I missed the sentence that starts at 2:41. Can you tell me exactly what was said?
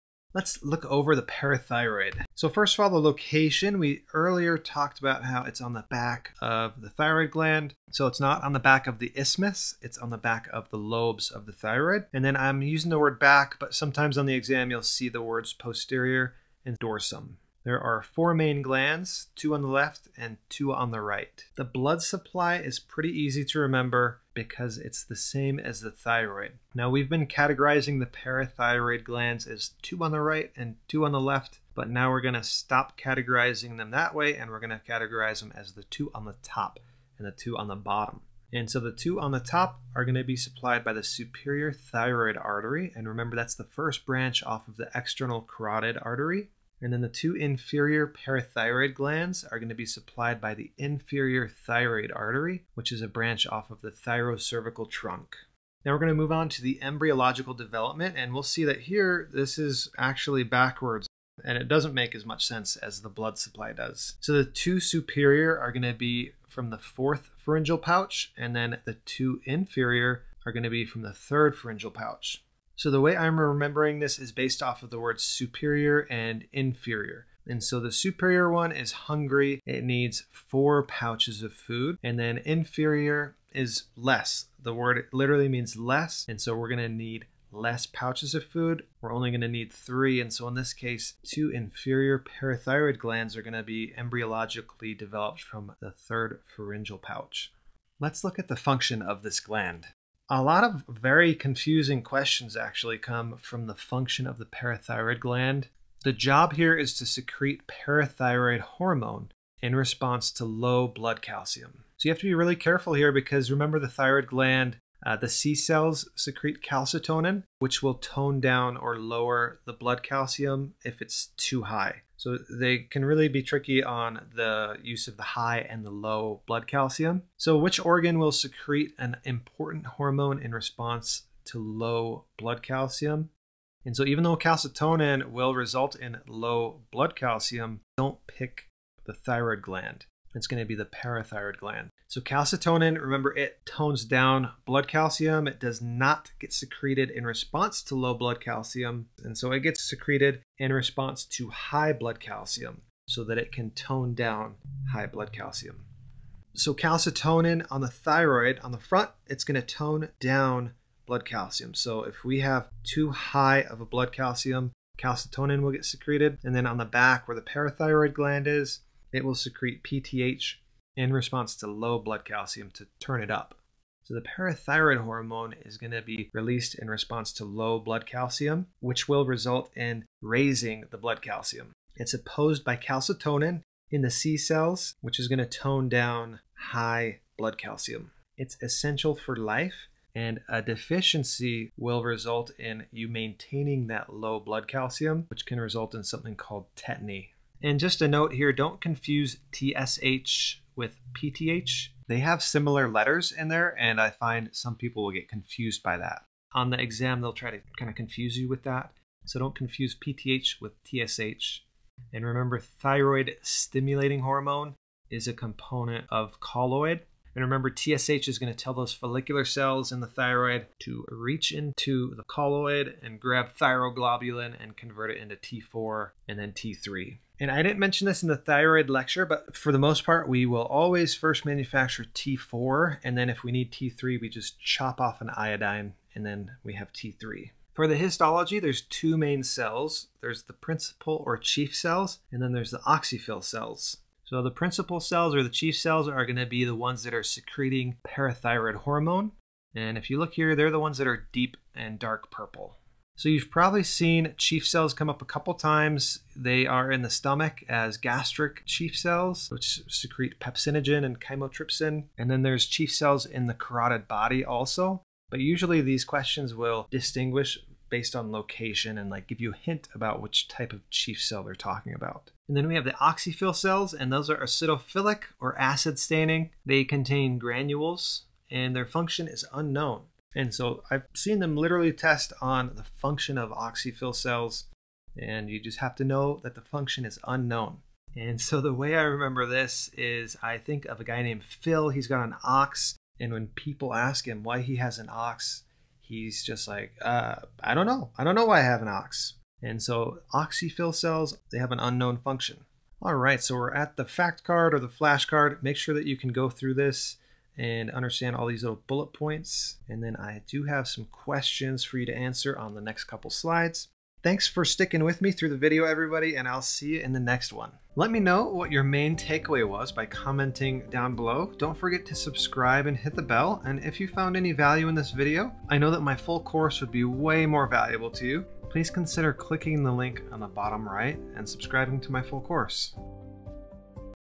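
So if we have too high of a blood calcium, calcitonin will get secreted.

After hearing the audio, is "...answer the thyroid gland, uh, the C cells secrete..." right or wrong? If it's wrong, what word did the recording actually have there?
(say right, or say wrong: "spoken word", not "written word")
wrong: "remember", not "answer".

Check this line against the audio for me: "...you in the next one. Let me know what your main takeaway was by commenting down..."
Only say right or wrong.
right.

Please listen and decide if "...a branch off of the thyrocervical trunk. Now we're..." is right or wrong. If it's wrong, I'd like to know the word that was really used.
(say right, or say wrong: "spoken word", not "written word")
right.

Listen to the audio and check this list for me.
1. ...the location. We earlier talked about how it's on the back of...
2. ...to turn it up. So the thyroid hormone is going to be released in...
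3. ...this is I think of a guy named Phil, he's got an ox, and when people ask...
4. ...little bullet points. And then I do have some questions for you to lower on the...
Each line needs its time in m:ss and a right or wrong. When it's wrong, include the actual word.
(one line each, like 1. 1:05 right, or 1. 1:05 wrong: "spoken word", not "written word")
1. 0:02 right
2. 2:52 wrong: "parathyroid", not "thyroid"
3. 4:49 right
4. 5:08 wrong: "answer", not "lower".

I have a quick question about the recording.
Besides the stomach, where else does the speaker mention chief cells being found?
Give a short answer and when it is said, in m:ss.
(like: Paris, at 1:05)
Carotid body, at 4:23.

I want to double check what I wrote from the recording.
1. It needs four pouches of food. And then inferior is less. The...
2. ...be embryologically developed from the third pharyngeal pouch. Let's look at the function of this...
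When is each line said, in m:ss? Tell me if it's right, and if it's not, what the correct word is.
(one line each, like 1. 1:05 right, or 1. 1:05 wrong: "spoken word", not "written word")
1. 1:19 right
2. 1:33 right.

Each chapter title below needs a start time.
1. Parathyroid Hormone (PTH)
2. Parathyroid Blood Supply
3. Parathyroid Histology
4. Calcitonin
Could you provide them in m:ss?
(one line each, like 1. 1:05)
1. 2:53
2. 0:21
3. 3:57
4. 1:37.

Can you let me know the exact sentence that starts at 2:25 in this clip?
It does not get secreted in response to low blood calcium.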